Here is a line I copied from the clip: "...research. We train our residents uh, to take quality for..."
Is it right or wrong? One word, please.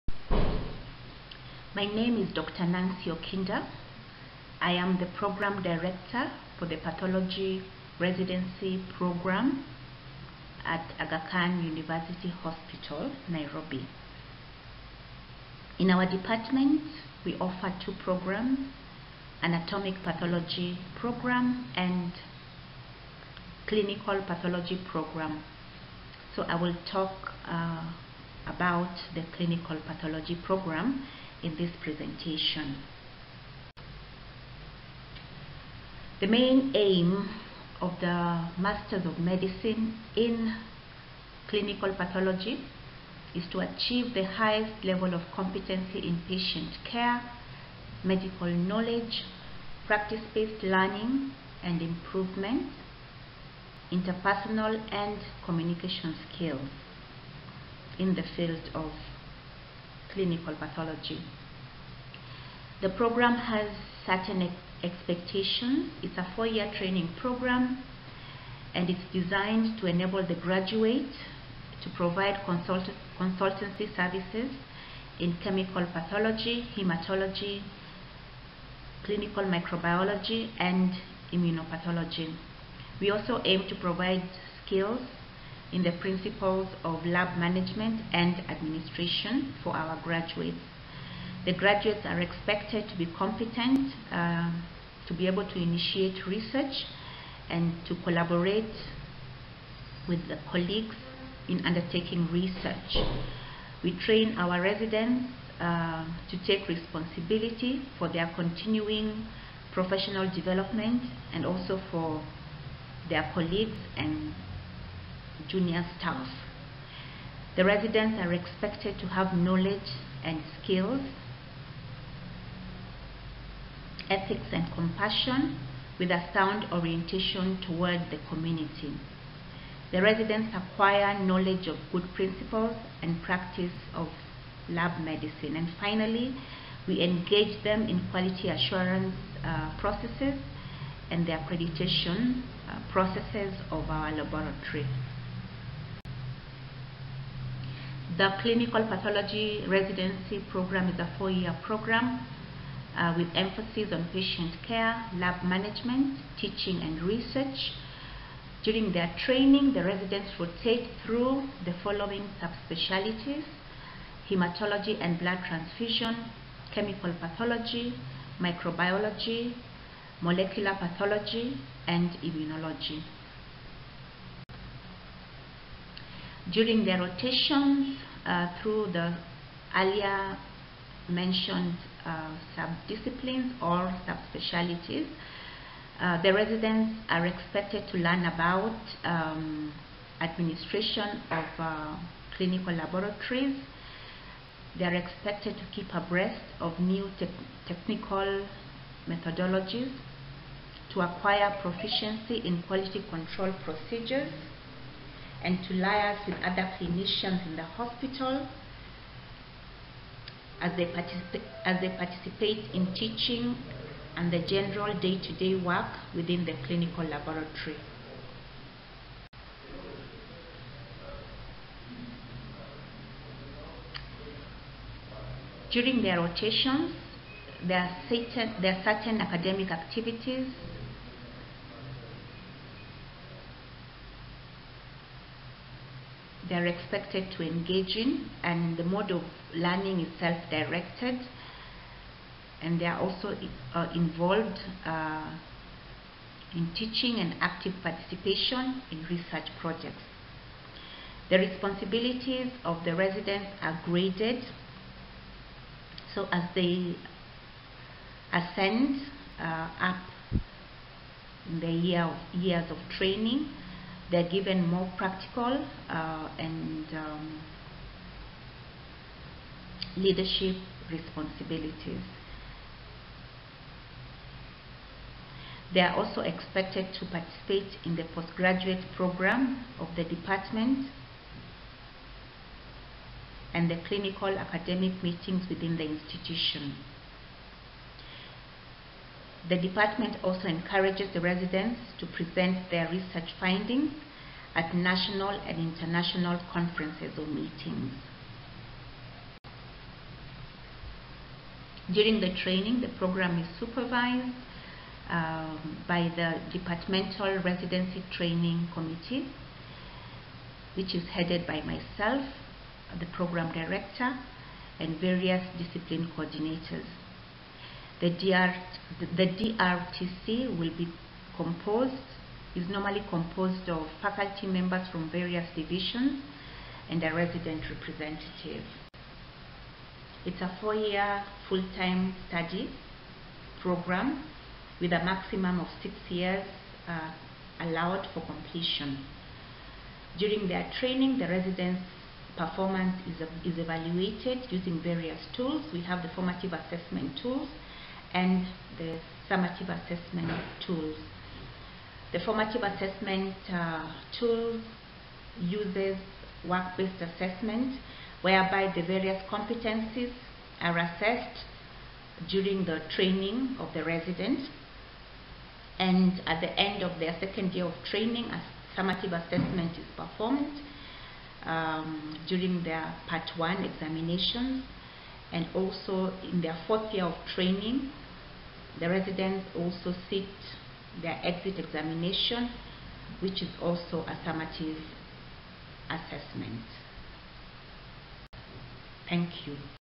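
wrong.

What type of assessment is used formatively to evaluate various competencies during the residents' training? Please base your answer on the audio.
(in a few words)
Work-based assessment.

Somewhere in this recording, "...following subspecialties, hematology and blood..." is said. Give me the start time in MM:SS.
02:41.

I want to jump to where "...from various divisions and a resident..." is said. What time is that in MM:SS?
05:24.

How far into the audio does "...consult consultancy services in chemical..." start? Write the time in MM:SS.
01:12.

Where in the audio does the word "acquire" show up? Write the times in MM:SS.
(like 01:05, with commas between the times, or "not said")
02:10, 03:21.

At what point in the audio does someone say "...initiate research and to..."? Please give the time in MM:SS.
01:35.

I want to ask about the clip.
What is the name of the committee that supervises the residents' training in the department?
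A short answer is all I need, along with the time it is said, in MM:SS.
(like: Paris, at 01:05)
Departmental Residency Training Committee, at 05:06.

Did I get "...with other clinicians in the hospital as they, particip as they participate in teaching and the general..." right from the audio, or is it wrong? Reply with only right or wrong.
right.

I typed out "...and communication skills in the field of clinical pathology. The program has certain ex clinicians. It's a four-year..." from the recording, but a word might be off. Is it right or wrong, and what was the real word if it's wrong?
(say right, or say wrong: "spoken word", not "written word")
wrong: "expectations", not "clinicians".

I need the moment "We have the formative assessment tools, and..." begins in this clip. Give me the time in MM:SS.
05:45.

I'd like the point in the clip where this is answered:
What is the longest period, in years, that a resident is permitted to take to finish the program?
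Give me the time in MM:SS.
05:35.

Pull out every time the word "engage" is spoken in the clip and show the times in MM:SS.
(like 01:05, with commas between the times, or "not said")
02:17, 03:57.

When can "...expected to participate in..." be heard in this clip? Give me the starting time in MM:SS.
04:36.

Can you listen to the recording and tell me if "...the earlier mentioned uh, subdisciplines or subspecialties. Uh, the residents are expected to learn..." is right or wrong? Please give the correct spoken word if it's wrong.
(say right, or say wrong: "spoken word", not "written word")
right.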